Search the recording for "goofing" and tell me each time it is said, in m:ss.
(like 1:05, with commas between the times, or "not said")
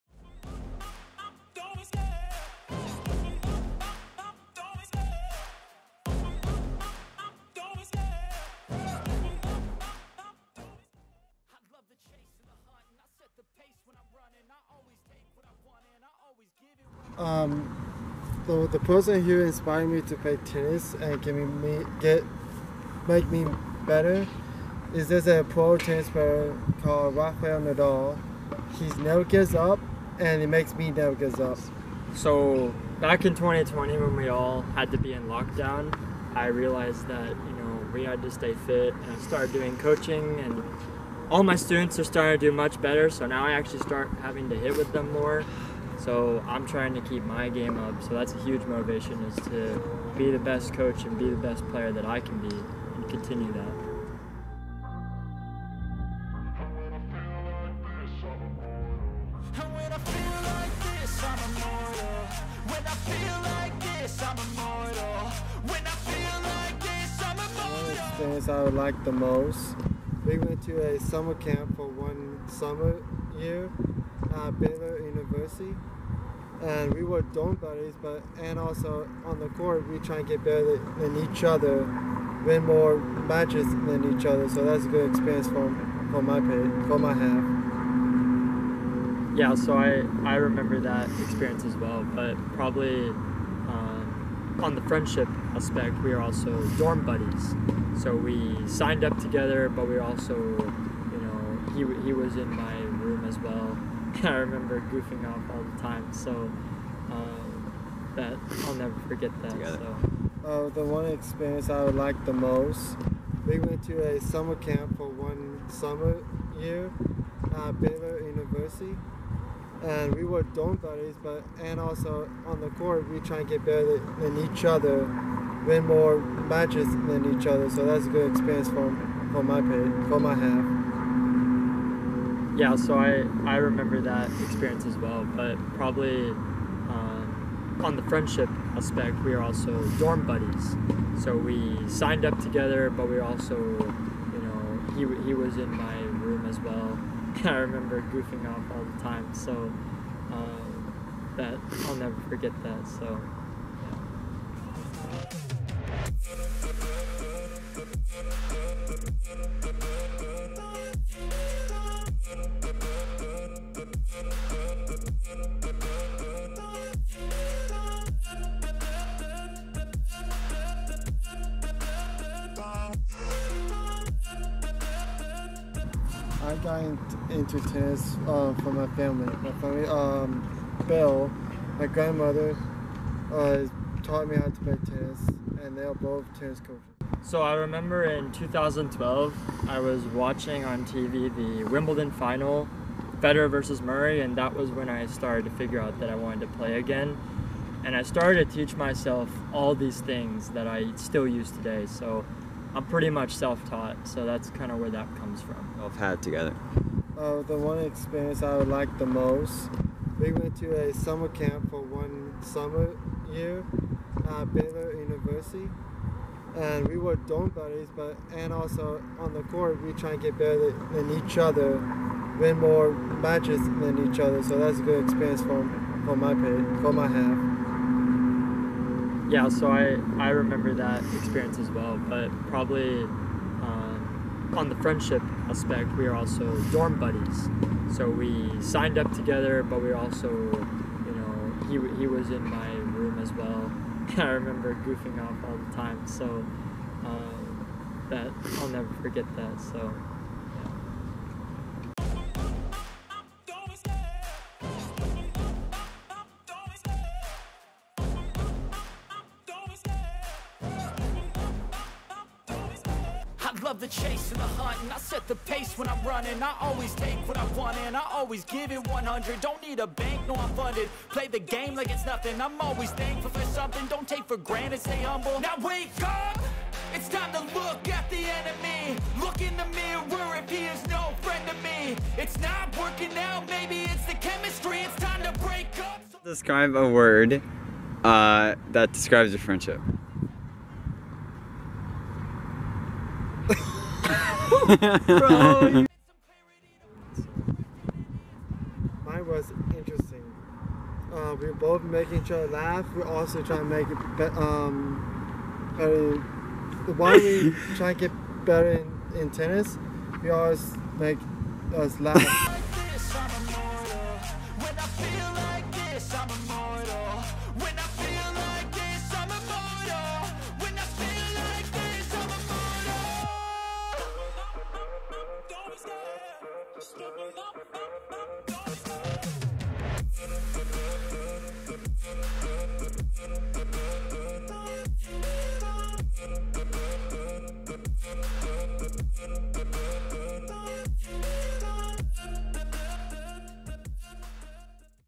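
1:44, 2:28, 4:04.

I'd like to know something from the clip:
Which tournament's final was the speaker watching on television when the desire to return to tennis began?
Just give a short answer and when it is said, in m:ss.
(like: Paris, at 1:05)
Wimbledon, at 3:11.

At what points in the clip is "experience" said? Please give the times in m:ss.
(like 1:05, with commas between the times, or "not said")
1:25, 1:31, 1:51, 2:08, 2:14, 3:27, 3:45, 3:51.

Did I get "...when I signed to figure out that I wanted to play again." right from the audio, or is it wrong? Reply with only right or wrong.
wrong.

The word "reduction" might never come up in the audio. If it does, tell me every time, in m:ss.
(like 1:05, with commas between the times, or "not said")
not said.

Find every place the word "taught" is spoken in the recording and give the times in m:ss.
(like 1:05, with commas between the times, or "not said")
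3:04, 3:23.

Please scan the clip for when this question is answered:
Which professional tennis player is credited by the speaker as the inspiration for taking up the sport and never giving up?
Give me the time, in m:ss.
0:27.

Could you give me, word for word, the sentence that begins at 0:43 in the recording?
So now I actually start having to hit with them more.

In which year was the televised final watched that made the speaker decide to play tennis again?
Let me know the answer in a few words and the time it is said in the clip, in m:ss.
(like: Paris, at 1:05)
2012, at 3:08.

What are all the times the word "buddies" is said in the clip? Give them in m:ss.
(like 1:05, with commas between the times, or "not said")
1:17, 1:37, 2:00, 2:20, 3:37, 3:56.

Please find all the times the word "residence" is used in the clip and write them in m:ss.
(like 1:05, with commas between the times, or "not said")
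not said.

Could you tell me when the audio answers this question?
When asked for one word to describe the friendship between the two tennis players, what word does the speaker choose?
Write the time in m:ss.
4:59.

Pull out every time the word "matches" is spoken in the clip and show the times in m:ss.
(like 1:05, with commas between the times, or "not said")
1:22, 2:06, 3:42.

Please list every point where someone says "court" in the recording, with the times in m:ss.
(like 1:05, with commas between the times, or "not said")
1:19, 2:02, 3:39.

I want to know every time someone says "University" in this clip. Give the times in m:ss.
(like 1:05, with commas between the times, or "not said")
1:15, 1:58, 3:34.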